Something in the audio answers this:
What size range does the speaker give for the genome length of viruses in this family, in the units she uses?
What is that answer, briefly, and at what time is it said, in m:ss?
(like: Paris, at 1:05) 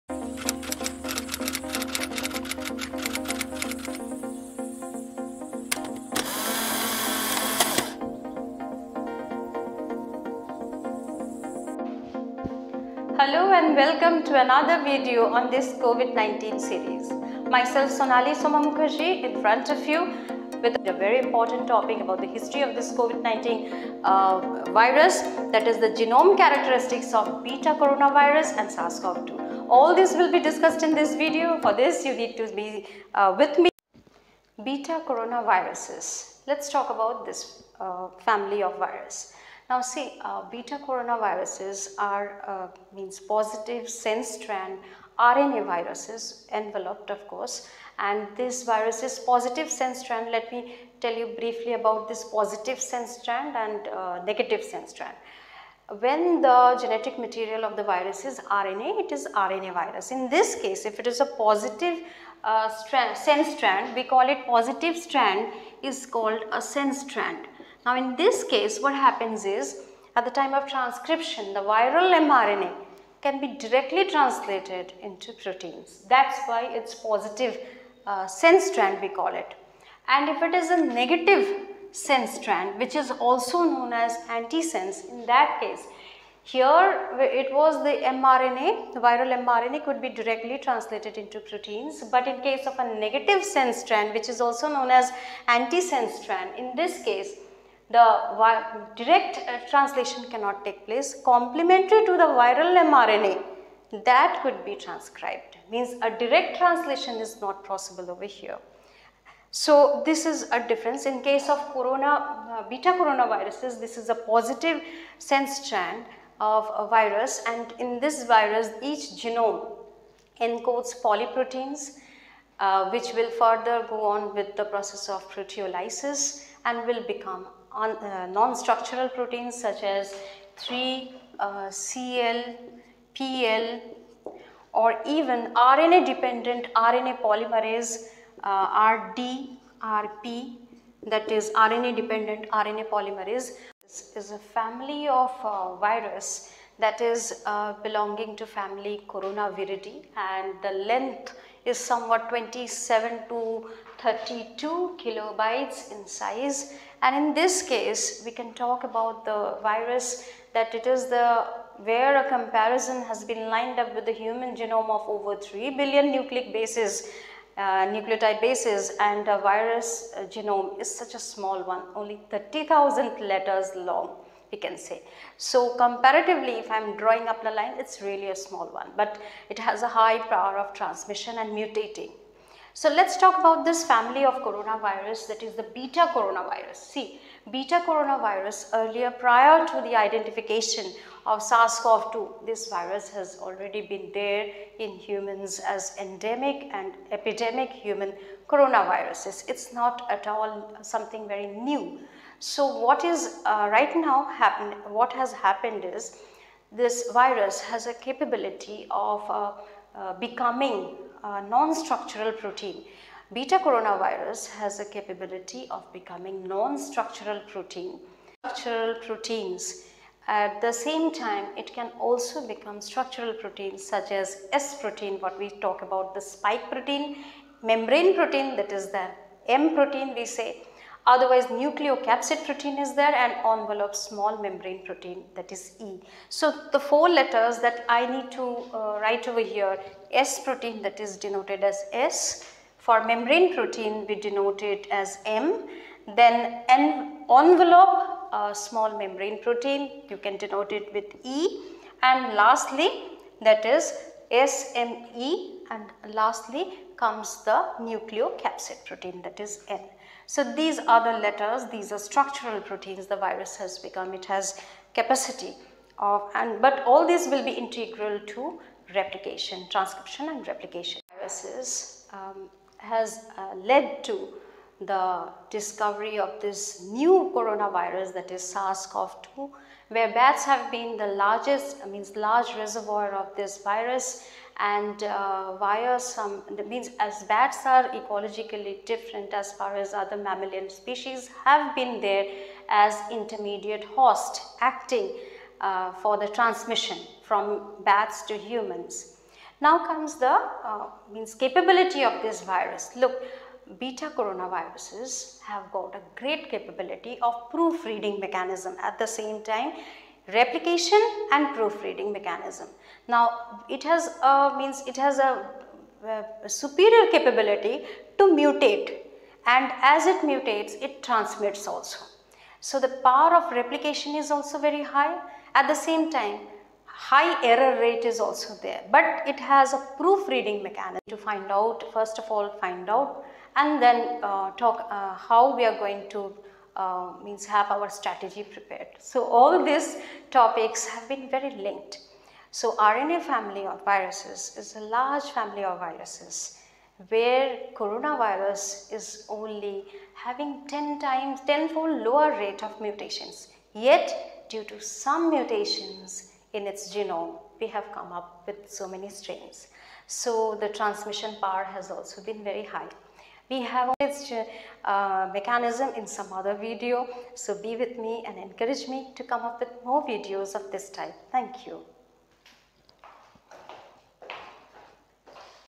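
27 to 32 kilobytes, at 2:32.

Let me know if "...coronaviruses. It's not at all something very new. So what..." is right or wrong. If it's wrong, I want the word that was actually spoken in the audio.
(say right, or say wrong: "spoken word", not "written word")
right.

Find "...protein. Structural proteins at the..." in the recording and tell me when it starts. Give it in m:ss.
3:37.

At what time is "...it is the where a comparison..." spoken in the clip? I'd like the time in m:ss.
2:40.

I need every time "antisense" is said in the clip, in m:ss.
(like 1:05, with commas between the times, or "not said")
1:24, 1:35.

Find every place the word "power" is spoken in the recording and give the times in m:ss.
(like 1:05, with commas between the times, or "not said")
3:00, 5:23, 6:01.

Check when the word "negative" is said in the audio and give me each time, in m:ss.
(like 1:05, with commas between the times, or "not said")
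0:54, 1:20, 1:32.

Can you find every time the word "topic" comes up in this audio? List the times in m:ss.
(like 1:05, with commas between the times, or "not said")
0:21, 5:40.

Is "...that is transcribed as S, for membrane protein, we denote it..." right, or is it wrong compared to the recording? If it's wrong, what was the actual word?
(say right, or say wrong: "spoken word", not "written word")
wrong: "denoted", not "transcribed".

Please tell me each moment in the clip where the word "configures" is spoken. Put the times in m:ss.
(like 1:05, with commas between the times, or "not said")
not said.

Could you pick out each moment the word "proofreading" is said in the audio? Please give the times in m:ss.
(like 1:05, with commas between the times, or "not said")
5:07, 5:11, 5:29.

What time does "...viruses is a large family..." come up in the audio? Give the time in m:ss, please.
5:43.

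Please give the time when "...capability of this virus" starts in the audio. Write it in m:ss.
5:01.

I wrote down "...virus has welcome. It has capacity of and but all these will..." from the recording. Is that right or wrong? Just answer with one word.
wrong.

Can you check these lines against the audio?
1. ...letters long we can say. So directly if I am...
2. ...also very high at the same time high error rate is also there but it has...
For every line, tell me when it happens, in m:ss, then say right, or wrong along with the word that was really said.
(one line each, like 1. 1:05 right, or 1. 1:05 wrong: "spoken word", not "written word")
1. 2:53 wrong: "comparatively", not "directly"
2. 5:24 right.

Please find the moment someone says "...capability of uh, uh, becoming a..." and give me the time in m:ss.
3:27.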